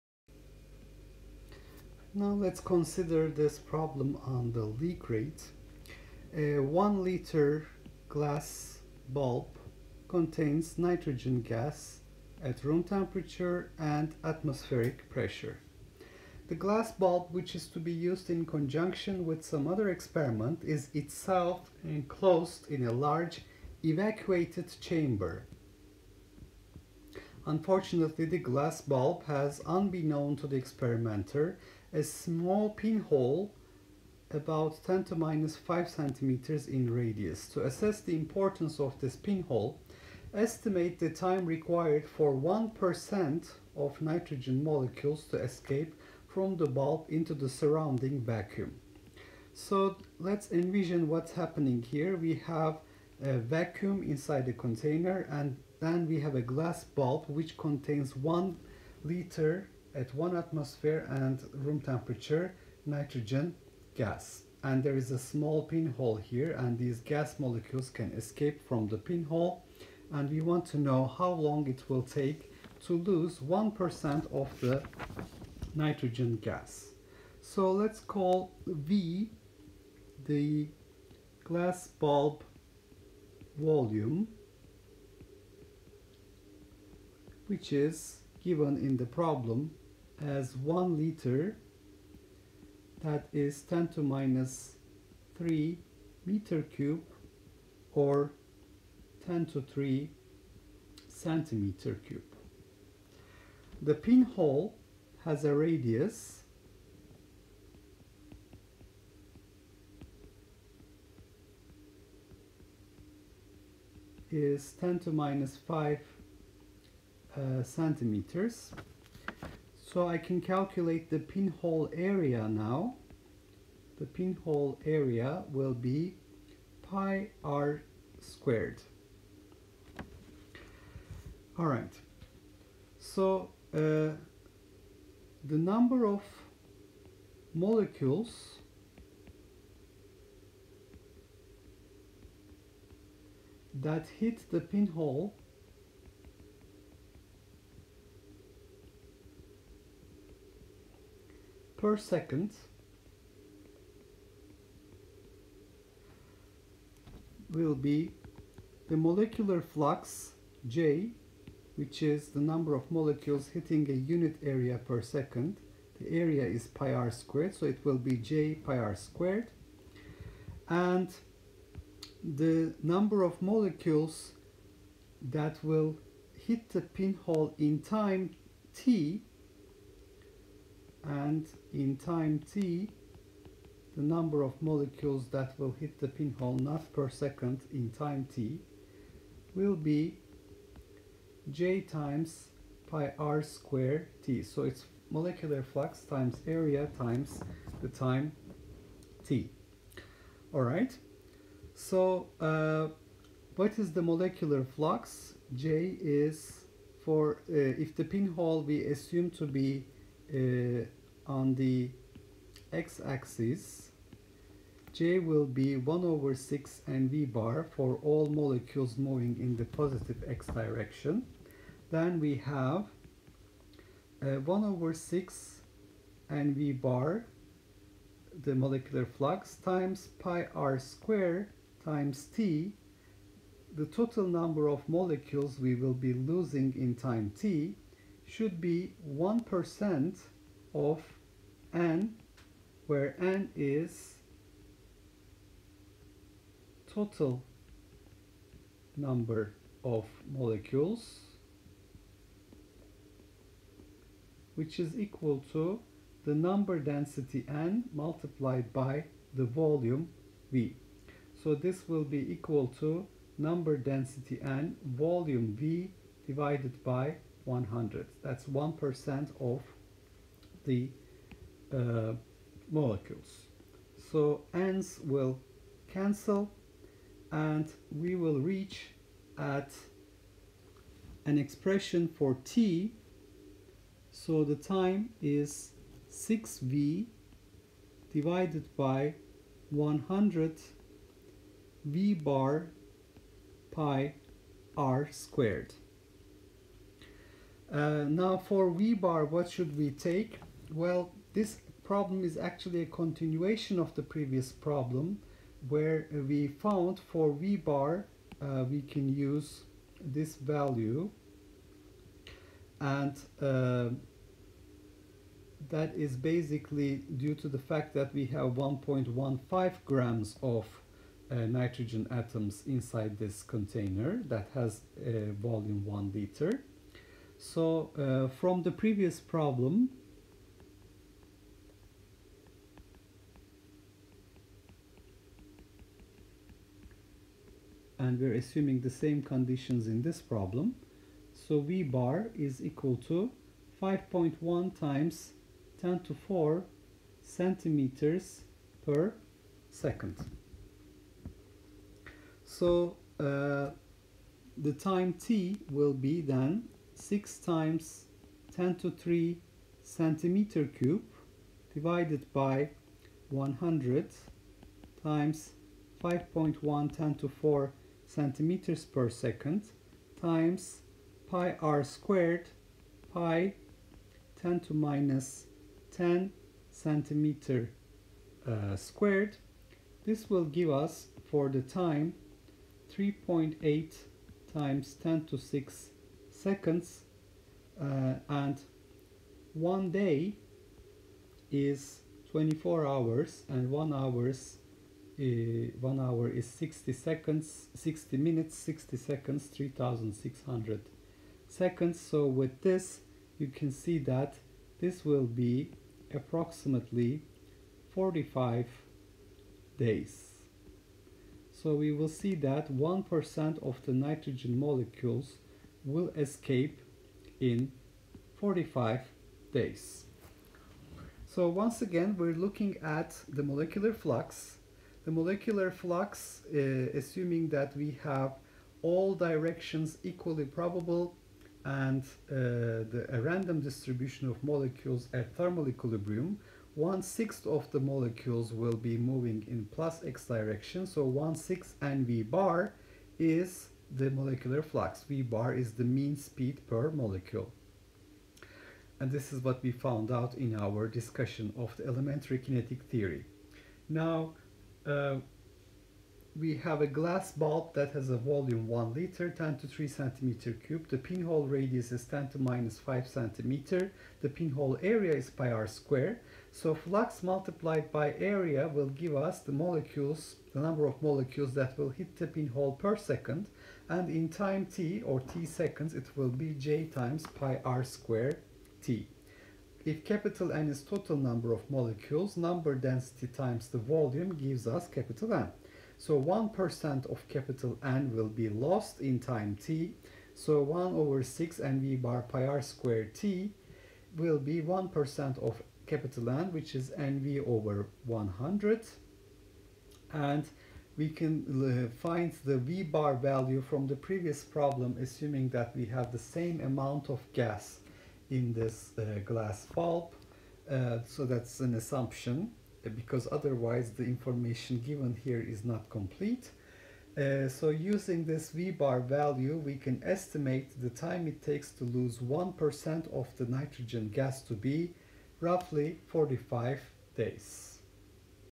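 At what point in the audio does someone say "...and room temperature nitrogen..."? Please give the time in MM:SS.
01:01.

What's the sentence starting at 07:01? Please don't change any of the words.
So once again, we're looking at the molecular flux.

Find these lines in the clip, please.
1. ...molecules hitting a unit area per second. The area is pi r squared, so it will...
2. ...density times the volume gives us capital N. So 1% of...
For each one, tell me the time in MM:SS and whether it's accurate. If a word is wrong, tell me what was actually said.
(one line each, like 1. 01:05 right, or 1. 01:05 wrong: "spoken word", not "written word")
1. 02:42 right
2. 08:02 right.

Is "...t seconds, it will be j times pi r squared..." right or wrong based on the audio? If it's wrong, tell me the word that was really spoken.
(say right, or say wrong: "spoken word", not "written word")
right.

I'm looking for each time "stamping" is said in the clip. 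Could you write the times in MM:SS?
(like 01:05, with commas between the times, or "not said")
not said.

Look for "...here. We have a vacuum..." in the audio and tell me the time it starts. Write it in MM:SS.
00:51.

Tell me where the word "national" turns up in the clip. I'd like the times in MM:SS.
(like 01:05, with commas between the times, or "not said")
not said.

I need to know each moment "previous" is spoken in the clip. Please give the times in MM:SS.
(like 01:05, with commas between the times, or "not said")
05:04, 05:28, 08:24.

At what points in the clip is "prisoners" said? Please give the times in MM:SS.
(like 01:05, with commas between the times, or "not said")
not said.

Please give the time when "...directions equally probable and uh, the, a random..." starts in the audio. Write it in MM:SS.
07:09.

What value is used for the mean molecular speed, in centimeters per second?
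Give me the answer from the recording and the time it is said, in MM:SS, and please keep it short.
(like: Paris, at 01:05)
5.1 x 10^4 cm/s, at 05:43.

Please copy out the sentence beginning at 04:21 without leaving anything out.
So this will be equal to number density n volume v divided by 100.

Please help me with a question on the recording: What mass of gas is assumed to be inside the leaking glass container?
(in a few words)
1.15 grams.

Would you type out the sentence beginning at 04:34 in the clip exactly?
So ends will cancel and we will reach at an expression for t.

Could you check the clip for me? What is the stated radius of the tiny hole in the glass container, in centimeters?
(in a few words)
10^-5 cm.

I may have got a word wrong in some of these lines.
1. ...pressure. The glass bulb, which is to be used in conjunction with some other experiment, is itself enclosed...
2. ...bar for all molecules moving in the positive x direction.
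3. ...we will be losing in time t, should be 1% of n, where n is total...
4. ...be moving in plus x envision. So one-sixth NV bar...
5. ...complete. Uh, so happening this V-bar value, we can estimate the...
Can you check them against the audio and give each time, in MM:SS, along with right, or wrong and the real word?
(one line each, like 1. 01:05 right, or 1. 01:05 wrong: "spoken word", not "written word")
1. 00:15 right
2. 03:37 right
3. 03:55 right
4. 07:18 wrong: "direction", not "envision"
5. 08:35 wrong: "using", not "happening".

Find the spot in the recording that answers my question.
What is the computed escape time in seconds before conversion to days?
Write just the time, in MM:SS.
06:22.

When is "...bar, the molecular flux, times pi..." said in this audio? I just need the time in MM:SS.
03:46.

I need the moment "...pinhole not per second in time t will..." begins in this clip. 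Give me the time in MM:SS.
03:06.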